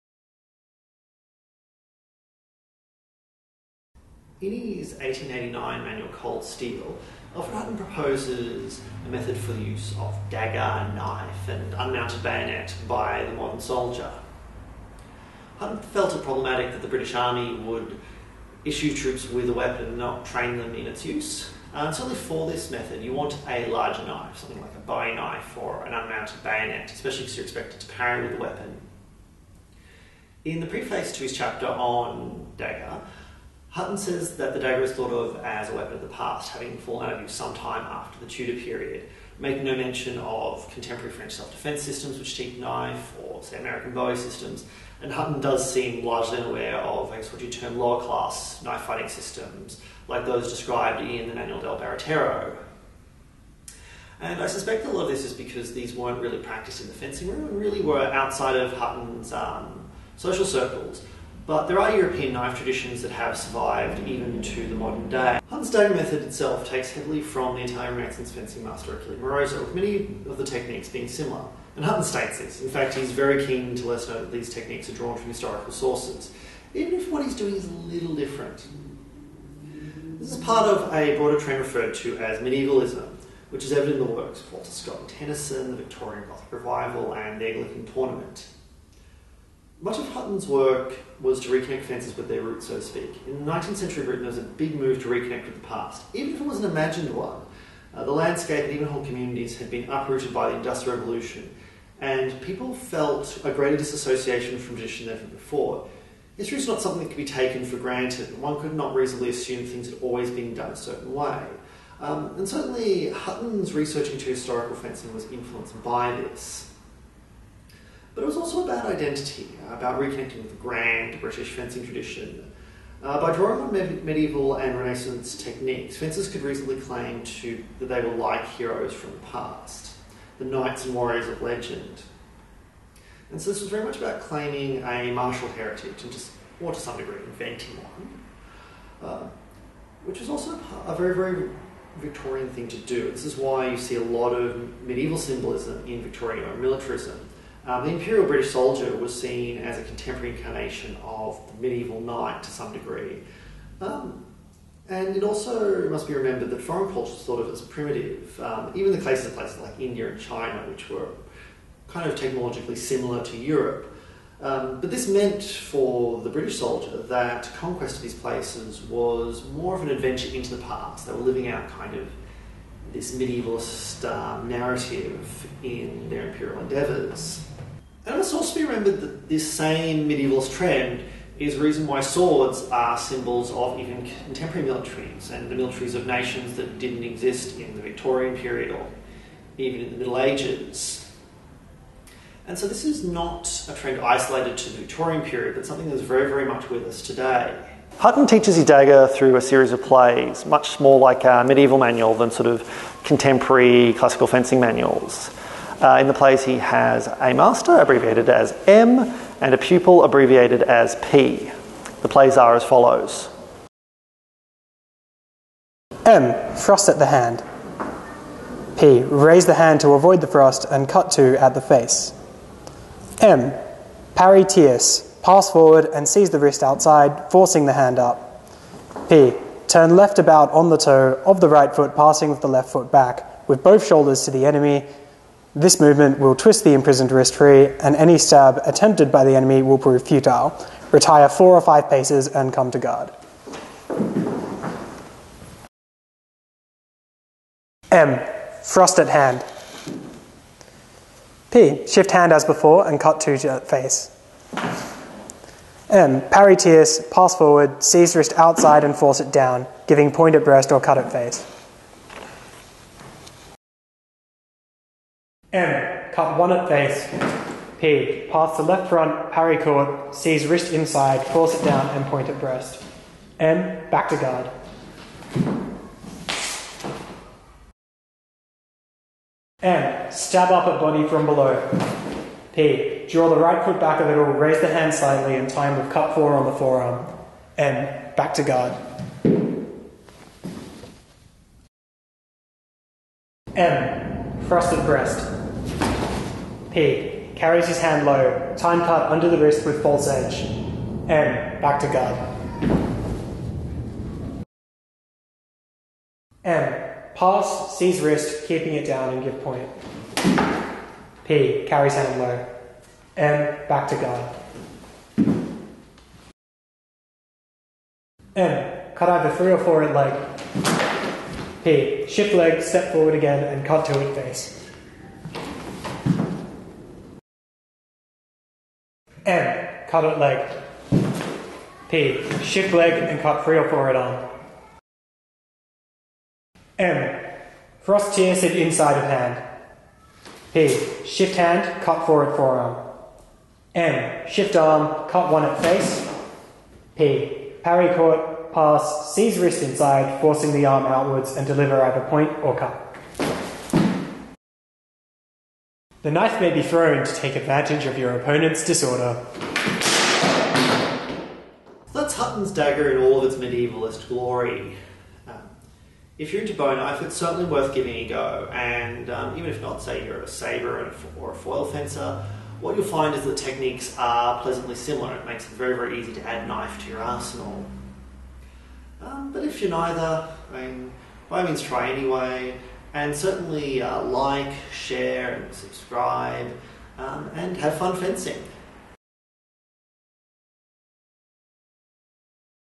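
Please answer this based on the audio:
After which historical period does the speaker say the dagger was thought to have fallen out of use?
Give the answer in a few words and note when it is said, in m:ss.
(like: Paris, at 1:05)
Tudor period, at 0:38.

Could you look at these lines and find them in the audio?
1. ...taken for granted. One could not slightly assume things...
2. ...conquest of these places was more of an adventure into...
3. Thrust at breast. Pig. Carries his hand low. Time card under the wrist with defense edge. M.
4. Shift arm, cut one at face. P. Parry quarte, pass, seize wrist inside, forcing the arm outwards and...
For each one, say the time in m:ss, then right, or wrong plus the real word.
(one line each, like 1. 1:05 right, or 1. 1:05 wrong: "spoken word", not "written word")
1. 1:47 wrong: "reasonably", not "slightly"
2. 2:47 right
3. 4:54 wrong: "false", not "defense"
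4. 5:44 right.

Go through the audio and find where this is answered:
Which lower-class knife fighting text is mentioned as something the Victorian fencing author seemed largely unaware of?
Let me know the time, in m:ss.
0:51.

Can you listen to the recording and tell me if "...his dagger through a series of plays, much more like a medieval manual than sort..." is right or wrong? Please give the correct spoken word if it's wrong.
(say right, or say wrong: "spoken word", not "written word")
right.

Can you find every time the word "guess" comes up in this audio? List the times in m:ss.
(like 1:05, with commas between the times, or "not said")
0:47.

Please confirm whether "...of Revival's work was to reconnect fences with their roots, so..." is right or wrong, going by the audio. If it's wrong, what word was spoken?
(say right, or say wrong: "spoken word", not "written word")
wrong: "Hutton", not "Revival".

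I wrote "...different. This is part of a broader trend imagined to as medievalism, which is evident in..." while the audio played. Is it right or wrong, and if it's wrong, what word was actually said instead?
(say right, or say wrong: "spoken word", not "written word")
wrong: "referred", not "imagined".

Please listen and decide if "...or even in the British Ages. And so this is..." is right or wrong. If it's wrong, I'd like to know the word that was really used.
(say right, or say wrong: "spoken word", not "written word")
wrong: "Middle", not "British".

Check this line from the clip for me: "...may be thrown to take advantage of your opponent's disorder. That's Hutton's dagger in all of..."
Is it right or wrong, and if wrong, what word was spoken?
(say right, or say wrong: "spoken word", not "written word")
right.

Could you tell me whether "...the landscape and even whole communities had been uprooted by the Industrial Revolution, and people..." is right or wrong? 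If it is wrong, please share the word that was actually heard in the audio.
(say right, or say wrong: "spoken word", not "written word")
right.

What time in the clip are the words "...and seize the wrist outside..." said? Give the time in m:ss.
3:45.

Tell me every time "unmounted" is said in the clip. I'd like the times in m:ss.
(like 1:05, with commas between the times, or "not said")
0:11, 0:25.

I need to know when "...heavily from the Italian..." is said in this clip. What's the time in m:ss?
1:06.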